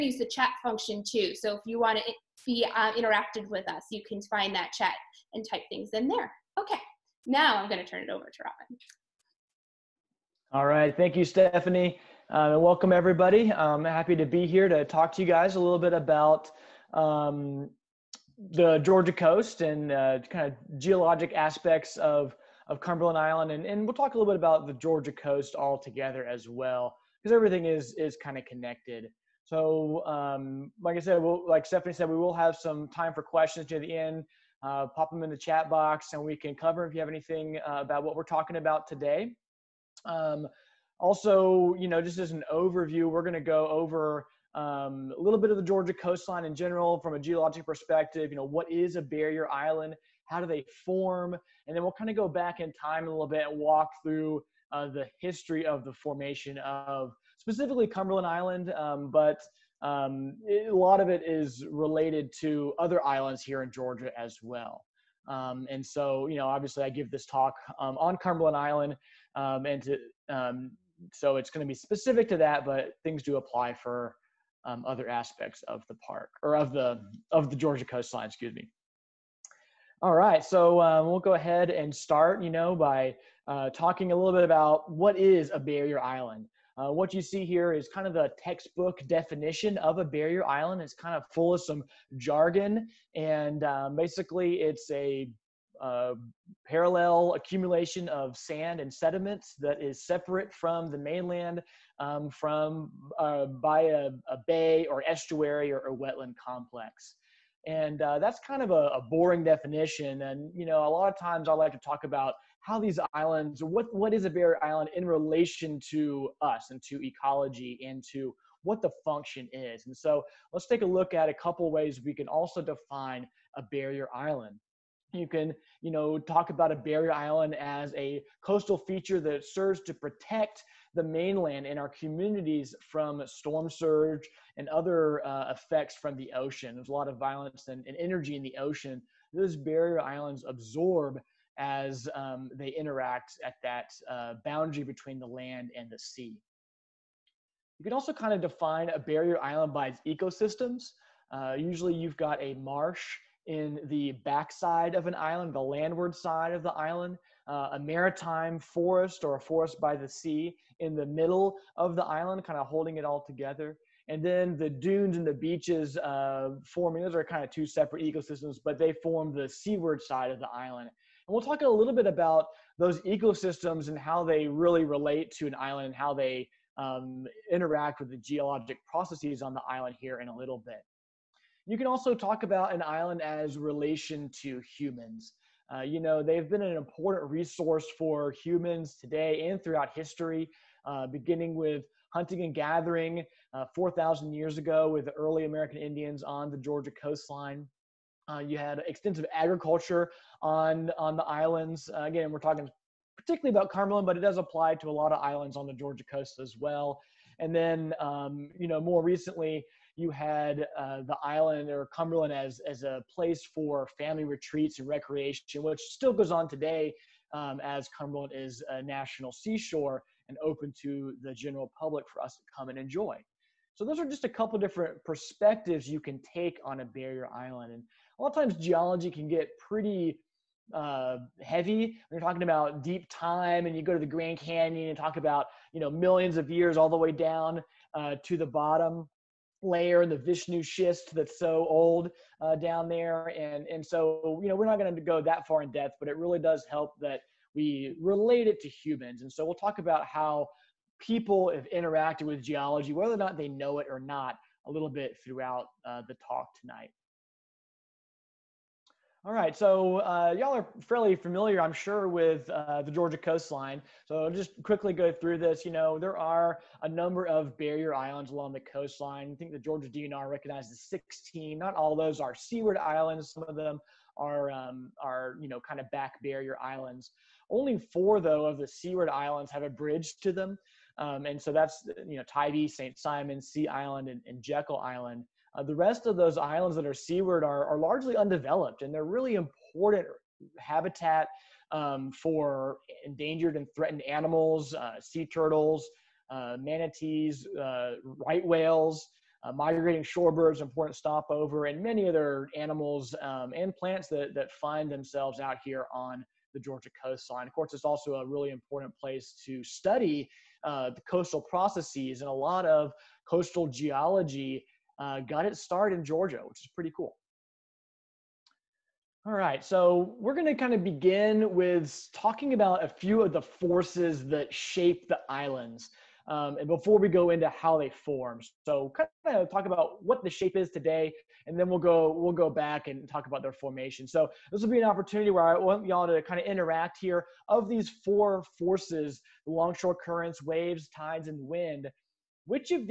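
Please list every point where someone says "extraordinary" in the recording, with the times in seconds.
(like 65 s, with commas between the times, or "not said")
not said.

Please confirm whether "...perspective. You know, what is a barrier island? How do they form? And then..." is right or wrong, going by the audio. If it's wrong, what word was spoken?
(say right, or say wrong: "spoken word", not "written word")
right.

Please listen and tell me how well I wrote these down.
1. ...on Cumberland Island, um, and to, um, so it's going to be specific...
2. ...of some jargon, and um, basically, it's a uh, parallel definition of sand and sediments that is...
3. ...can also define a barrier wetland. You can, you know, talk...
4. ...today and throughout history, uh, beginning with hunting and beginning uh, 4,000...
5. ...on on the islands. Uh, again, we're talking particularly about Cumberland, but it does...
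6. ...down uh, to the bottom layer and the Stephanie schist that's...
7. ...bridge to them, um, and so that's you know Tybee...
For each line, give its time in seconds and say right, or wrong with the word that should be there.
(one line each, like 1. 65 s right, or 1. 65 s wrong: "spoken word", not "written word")
1. 67 s right
2. 91 s wrong: "accumulation", not "definition"
3. 122 s wrong: "island", not "wetland"
4. 189 s wrong: "gathering", not "beginning"
5. 200 s right
6. 237 s wrong: "Vishnu", not "Stephanie"
7. 279 s right.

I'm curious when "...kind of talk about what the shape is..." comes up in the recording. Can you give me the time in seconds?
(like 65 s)
328 s.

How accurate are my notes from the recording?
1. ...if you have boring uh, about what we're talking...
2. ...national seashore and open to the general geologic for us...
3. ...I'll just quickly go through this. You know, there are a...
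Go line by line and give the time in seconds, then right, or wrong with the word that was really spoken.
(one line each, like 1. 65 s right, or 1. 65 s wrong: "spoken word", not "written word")
1. 36 s wrong: "anything", not "boring"
2. 218 s wrong: "public", not "geologic"
3. 264 s right.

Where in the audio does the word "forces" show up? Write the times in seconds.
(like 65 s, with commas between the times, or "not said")
323 s, 338 s.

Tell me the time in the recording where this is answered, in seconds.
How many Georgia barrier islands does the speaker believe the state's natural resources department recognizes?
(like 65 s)
270 s.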